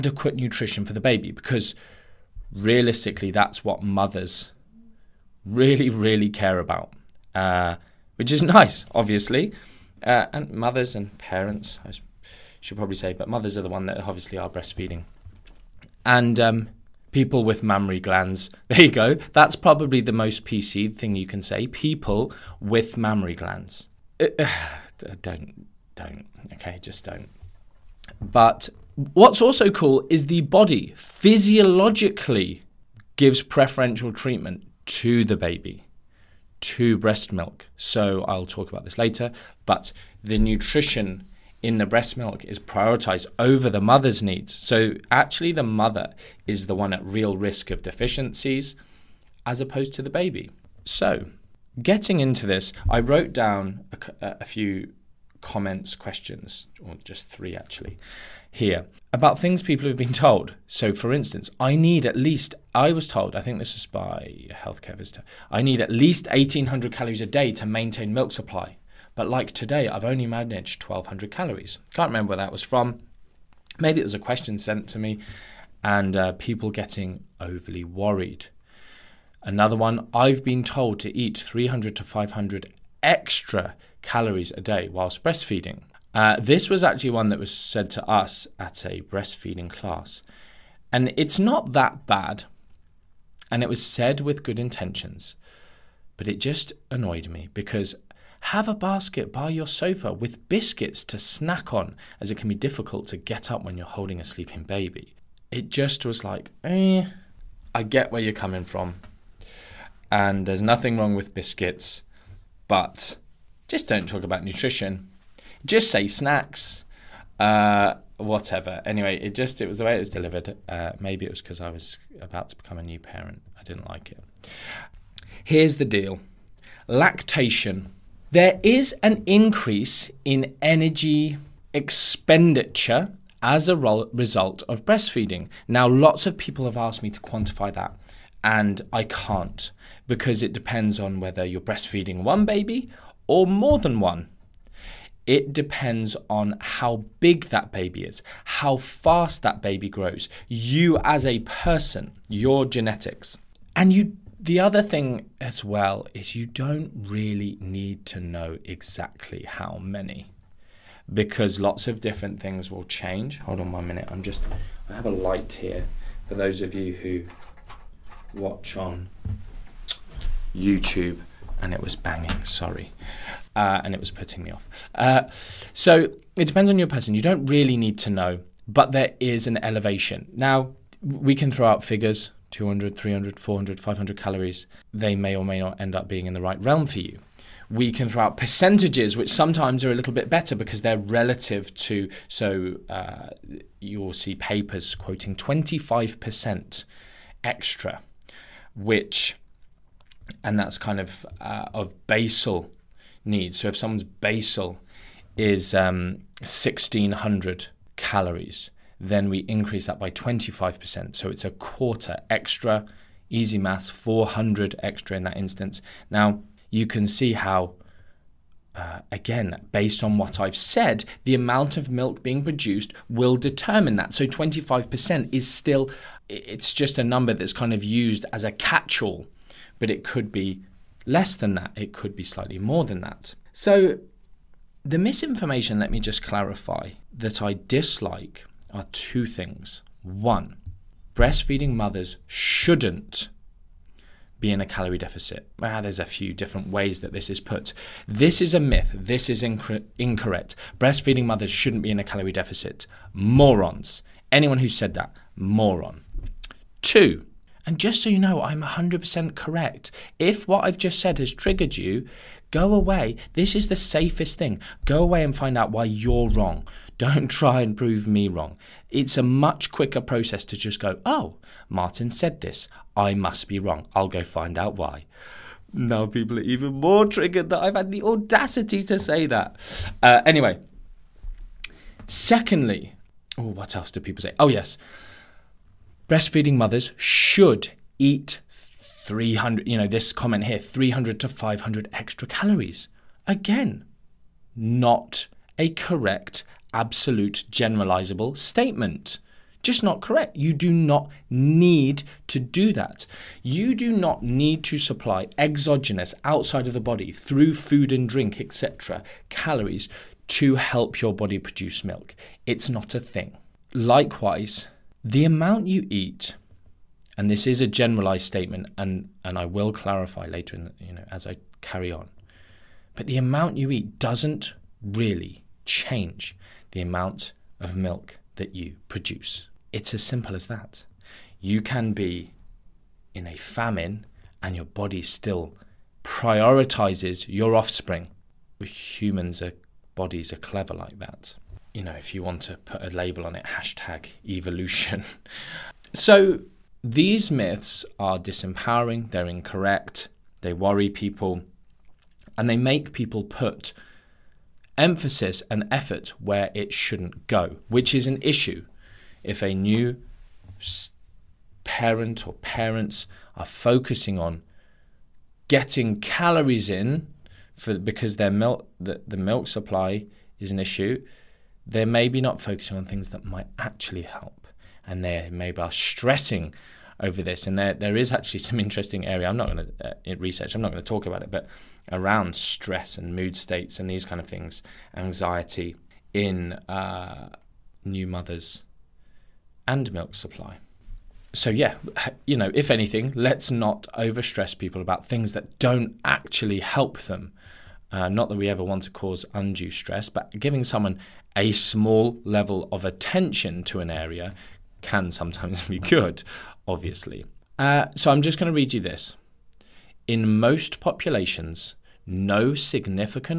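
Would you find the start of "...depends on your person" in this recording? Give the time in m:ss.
2:56.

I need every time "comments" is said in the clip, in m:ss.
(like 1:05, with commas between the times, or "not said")
0:55, 4:50.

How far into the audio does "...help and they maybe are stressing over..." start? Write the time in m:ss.
6:14.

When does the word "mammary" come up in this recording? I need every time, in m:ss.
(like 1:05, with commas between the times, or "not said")
0:17, 0:23.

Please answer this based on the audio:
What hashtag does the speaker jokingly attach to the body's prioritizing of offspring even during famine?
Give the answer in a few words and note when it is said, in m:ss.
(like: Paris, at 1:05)
evolution, at 5:43.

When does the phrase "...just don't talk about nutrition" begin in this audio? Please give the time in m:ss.
1:53.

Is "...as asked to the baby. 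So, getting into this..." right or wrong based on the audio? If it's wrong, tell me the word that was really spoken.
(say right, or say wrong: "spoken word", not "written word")
wrong: "opposed", not "asked".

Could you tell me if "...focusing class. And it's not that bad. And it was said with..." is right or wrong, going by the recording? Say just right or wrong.
wrong.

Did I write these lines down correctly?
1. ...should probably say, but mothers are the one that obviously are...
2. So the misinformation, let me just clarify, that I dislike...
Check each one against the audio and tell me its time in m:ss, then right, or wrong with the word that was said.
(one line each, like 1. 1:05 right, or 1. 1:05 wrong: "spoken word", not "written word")
1. 0:12 right
2. 3:53 right.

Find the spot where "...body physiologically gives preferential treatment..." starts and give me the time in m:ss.
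0:30.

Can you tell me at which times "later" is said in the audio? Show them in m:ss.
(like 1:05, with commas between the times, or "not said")
0:38, 5:20.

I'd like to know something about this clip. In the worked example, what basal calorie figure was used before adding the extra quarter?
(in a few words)
1600 calories.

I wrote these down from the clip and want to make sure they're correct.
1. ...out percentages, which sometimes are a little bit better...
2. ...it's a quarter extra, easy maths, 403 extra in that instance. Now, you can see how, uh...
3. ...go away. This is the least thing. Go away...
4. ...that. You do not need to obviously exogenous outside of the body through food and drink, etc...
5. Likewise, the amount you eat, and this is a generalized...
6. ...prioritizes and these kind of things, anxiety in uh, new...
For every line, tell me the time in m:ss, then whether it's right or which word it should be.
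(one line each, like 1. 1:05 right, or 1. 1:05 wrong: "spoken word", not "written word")
1. 3:08 right
2. 3:31 wrong: "400", not "403"
3. 4:22 wrong: "safest", not "least"
4. 5:02 wrong: "supply", not "obviously"
5. 5:13 right
6. 6:23 wrong: "states", not "prioritizes".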